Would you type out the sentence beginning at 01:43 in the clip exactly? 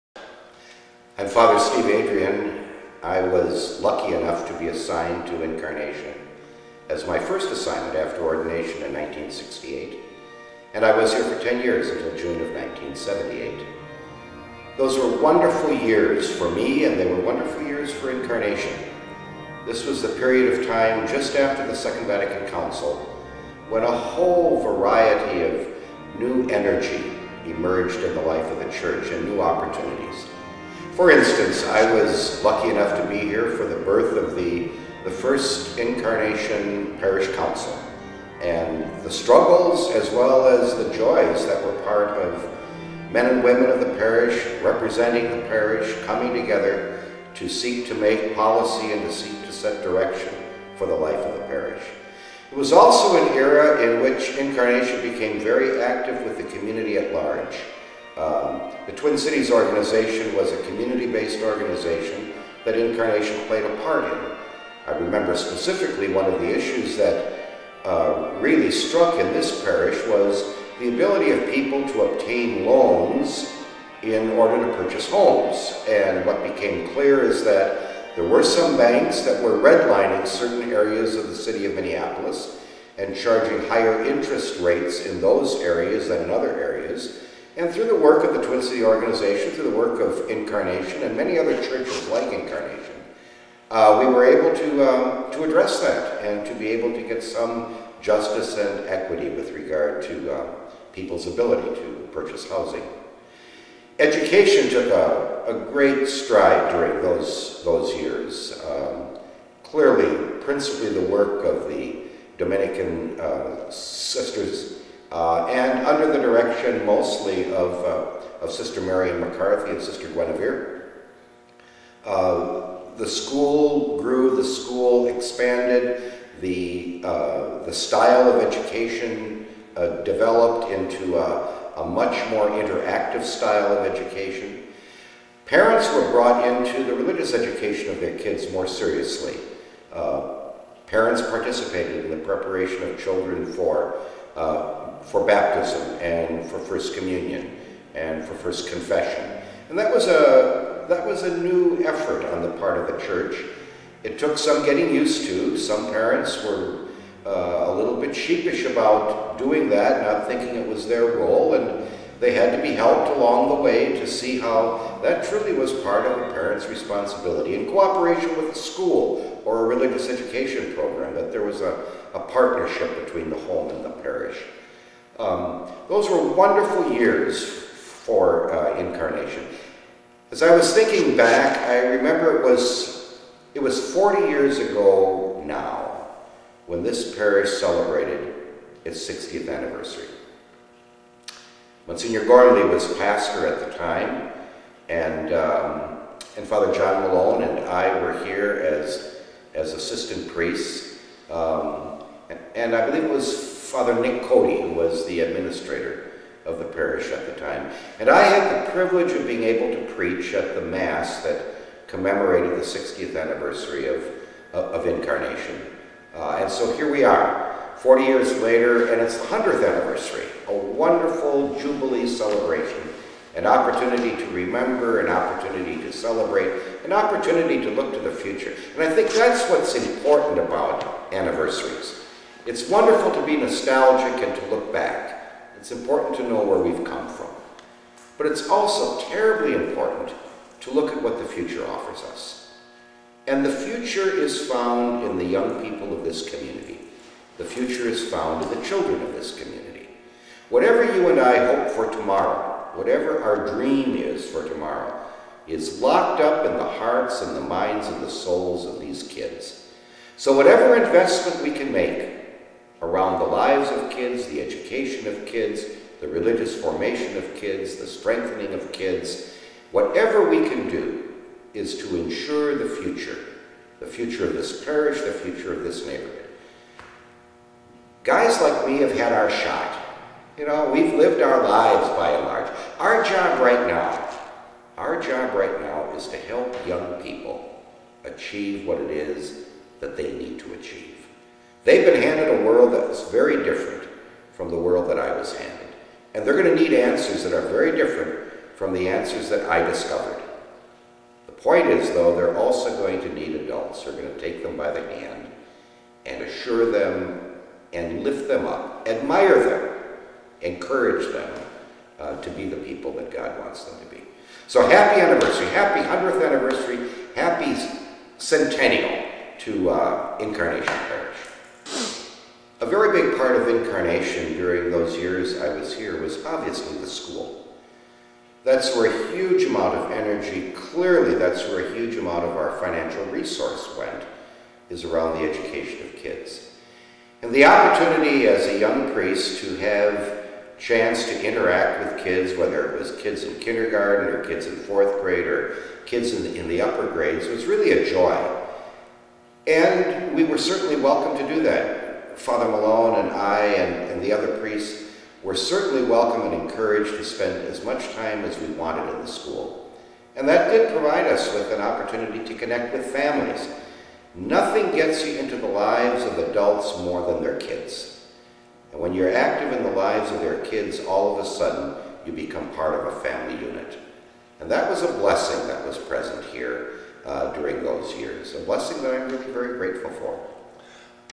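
Education took a, a great stride during those, those years.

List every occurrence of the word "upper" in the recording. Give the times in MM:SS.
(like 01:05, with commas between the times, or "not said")
05:46.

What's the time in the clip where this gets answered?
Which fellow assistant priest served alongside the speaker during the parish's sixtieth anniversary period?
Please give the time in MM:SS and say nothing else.
03:16.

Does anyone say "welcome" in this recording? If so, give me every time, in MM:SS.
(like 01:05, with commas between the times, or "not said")
05:50, 05:55.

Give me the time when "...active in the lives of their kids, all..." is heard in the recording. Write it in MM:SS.
06:09.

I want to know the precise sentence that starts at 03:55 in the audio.
It's important to know where we've come from.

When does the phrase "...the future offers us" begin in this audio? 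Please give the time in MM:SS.
04:01.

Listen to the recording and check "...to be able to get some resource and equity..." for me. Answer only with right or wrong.
wrong.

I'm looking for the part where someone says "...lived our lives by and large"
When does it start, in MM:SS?
04:40.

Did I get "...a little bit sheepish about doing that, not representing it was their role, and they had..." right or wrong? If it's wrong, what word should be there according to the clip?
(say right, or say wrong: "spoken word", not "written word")
wrong: "thinking", not "representing".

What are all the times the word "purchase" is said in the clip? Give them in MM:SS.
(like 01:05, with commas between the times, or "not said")
01:14, 01:42.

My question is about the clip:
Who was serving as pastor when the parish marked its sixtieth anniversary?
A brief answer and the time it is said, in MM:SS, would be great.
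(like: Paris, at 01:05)
Monsignor Gormley, at 03:11.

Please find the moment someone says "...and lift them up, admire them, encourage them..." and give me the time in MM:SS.
05:07.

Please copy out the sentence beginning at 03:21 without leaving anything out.
Um, and, and I believe it was Father Nick Cody, who was the administrator of the parish at the time.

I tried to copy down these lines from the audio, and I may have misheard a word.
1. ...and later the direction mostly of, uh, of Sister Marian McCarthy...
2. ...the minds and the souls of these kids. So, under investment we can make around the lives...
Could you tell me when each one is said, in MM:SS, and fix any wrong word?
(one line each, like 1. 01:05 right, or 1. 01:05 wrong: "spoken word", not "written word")
1. 01:55 wrong: "under", not "later"
2. 04:17 wrong: "whatever", not "under".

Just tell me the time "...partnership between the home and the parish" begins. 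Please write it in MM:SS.
02:52.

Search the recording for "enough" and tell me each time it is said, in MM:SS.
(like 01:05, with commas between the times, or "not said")
00:04, 00:32.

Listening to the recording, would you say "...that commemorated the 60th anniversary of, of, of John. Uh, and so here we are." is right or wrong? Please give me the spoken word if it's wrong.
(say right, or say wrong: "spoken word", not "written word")
wrong: "Incarnation", not "John".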